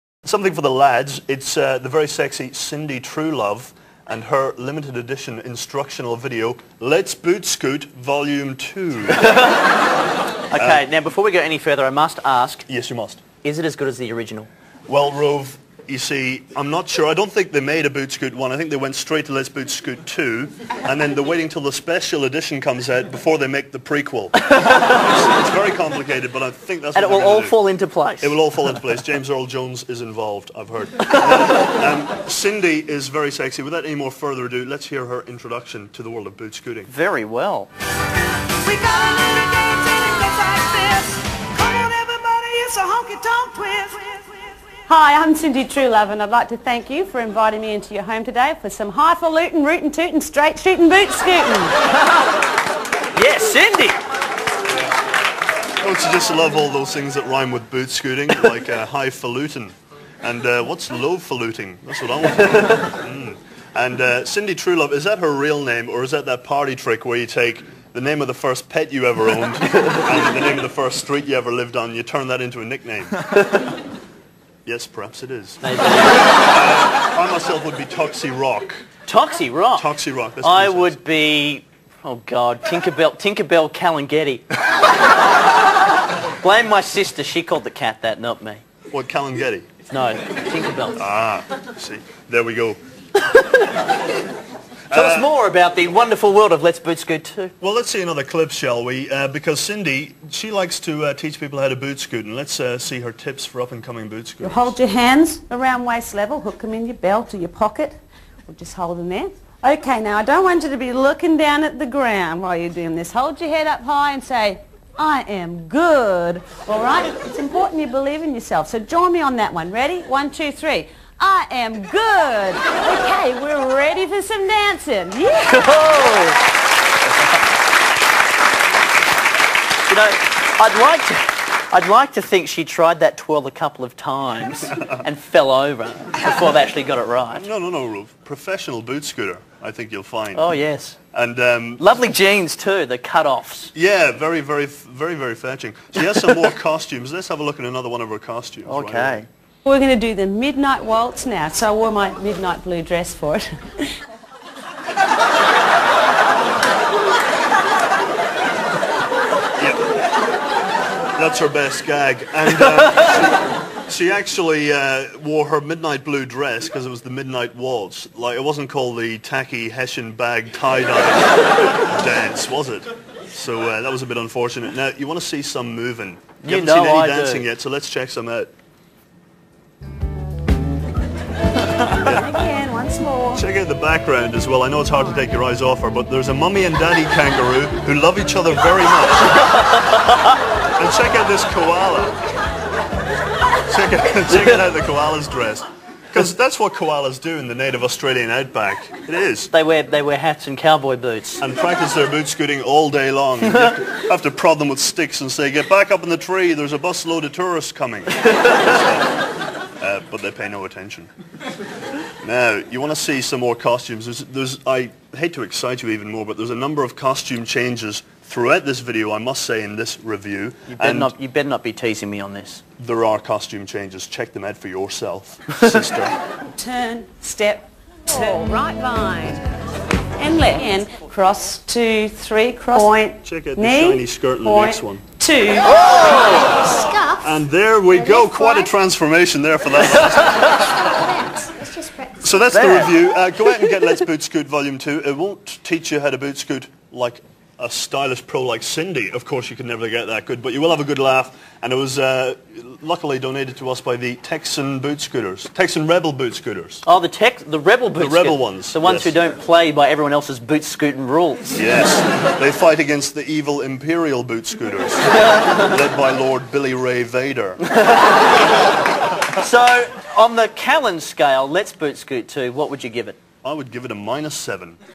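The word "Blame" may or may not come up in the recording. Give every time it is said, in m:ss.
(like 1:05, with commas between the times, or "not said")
1:26.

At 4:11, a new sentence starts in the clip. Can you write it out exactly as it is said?
And it was uh, luckily donated to us by the Texan boot scooters, Texan Rebel boot scooters.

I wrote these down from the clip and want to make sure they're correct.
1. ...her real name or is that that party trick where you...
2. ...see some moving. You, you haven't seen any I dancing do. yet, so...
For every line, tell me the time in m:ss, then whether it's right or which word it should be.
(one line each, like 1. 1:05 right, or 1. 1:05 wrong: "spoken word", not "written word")
1. 1:05 right
2. 2:55 right.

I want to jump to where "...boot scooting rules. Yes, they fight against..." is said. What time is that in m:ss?
4:20.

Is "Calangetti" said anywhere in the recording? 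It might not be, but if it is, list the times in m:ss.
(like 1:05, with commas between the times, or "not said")
1:23, 1:29.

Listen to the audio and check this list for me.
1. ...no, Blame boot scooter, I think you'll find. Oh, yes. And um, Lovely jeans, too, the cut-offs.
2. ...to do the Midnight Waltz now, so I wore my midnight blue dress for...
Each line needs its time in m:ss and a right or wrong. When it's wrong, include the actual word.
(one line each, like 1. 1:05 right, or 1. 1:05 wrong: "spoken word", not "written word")
1. 2:17 wrong: "Professional", not "Blame"
2. 2:29 right.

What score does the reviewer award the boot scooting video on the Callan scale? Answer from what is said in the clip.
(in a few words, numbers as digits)
-7.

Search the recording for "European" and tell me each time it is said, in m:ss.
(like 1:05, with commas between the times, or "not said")
not said.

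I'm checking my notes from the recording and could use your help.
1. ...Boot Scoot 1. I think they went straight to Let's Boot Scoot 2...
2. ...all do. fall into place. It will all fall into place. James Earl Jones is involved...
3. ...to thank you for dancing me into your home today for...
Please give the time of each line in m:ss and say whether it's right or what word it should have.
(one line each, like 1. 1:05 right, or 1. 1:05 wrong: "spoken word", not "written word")
1. 0:17 right
2. 0:27 right
3. 0:46 wrong: "inviting", not "dancing".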